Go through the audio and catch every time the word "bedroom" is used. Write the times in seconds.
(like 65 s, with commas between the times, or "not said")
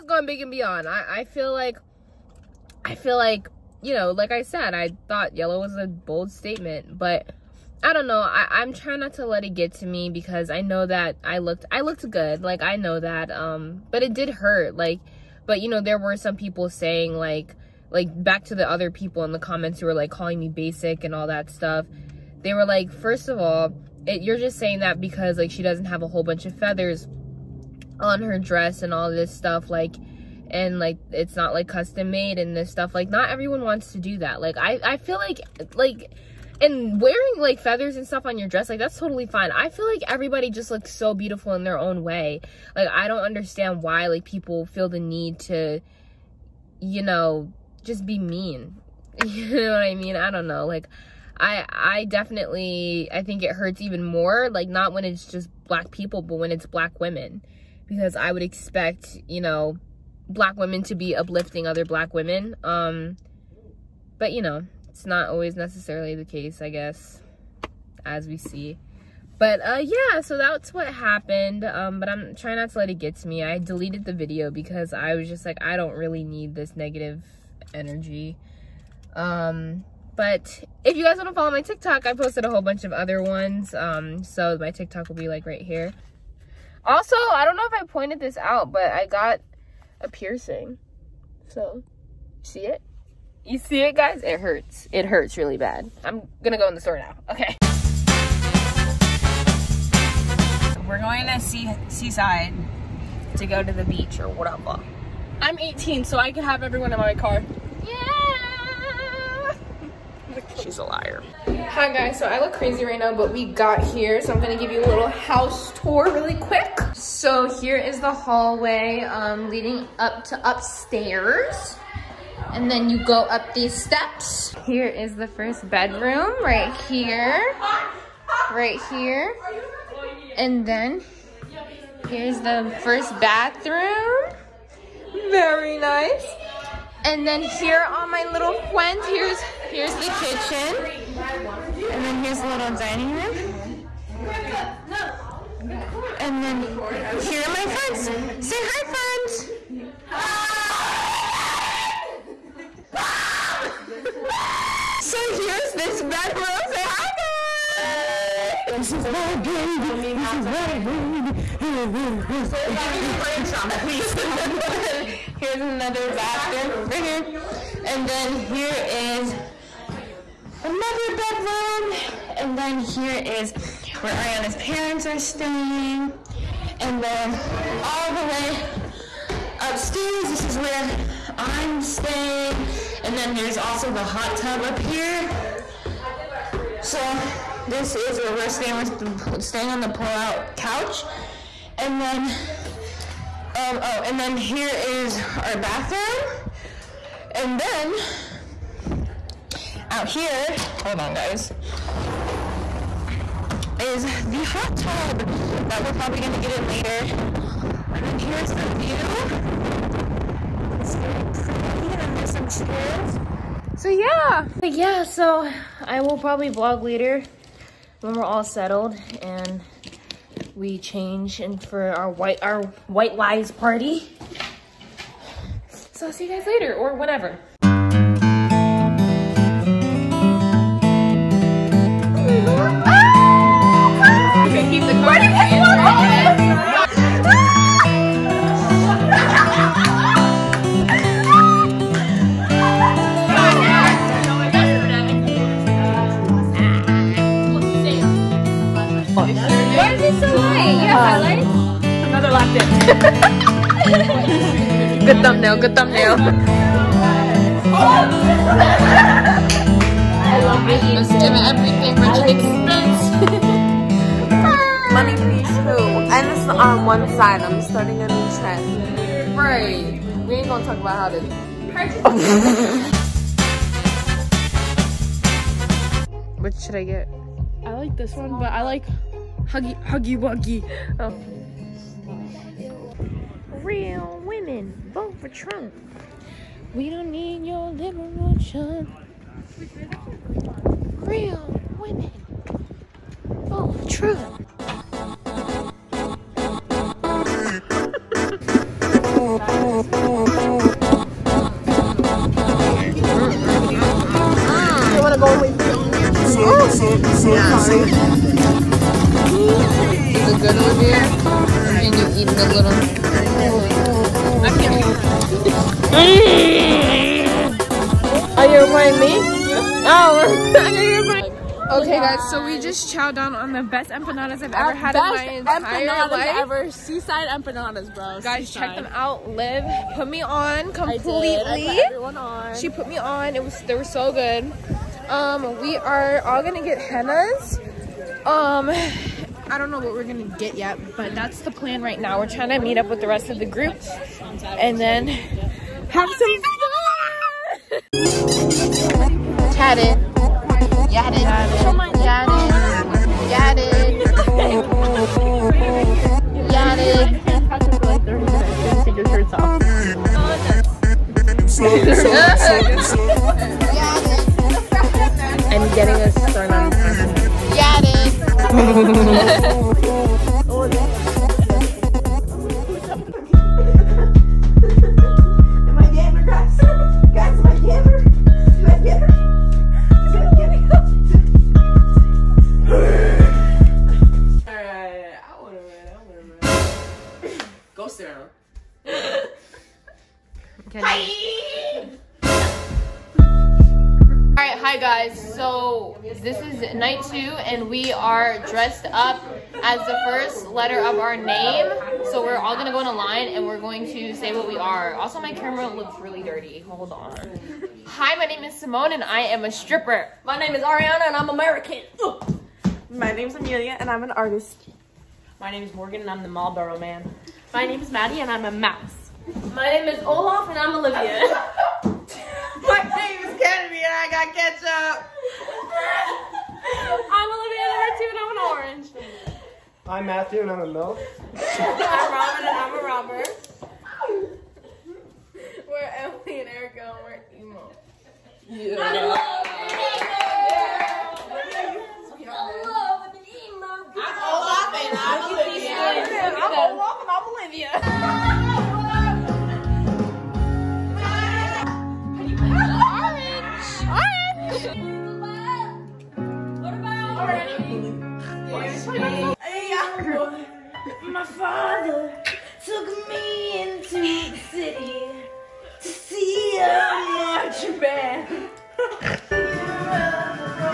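125 s, 171 s.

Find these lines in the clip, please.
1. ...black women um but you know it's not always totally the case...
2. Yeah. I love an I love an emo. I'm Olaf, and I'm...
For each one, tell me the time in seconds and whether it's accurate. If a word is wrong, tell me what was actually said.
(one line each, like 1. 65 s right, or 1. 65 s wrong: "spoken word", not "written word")
1. 61 s wrong: "necessarily", not "totally"
2. 438 s right.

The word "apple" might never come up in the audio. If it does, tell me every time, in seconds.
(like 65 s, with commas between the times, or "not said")
not said.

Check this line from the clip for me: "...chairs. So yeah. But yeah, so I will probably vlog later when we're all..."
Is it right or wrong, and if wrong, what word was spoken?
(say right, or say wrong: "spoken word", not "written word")
right.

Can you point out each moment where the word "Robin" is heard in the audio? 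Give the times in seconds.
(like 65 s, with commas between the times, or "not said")
432 s.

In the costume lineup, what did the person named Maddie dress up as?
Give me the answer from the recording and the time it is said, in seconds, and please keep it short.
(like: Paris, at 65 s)
A mouse, at 418 s.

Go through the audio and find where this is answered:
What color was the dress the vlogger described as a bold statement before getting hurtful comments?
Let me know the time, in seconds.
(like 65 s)
5 s.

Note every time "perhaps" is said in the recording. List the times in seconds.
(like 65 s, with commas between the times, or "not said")
not said.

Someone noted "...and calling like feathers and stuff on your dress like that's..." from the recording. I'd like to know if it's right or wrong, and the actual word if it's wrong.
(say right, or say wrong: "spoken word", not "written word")
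wrong: "wearing", not "calling".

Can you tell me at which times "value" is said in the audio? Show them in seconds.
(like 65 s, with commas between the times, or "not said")
not said.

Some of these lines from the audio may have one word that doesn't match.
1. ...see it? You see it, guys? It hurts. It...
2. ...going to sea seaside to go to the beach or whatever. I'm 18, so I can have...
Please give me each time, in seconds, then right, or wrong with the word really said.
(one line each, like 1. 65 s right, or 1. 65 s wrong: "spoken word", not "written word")
1. 92 s right
2. 100 s right.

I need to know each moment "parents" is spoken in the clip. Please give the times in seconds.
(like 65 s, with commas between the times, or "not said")
174 s.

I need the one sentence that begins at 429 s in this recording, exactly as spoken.
I'm Matthew, and I'm a milk.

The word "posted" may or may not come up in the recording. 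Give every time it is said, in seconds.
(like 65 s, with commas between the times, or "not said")
82 s.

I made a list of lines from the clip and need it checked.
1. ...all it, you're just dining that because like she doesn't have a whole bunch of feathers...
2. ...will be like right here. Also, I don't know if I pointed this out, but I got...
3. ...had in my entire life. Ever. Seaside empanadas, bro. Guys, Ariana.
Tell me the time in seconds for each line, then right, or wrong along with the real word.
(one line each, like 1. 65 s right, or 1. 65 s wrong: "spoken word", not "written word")
1. 23 s wrong: "saying", not "dining"
2. 85 s right
3. 324 s wrong: "Seaside", not "Ariana".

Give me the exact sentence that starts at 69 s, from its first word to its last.
But uh, yeah, so that's what happened.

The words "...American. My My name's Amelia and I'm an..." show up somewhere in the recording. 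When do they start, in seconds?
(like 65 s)
411 s.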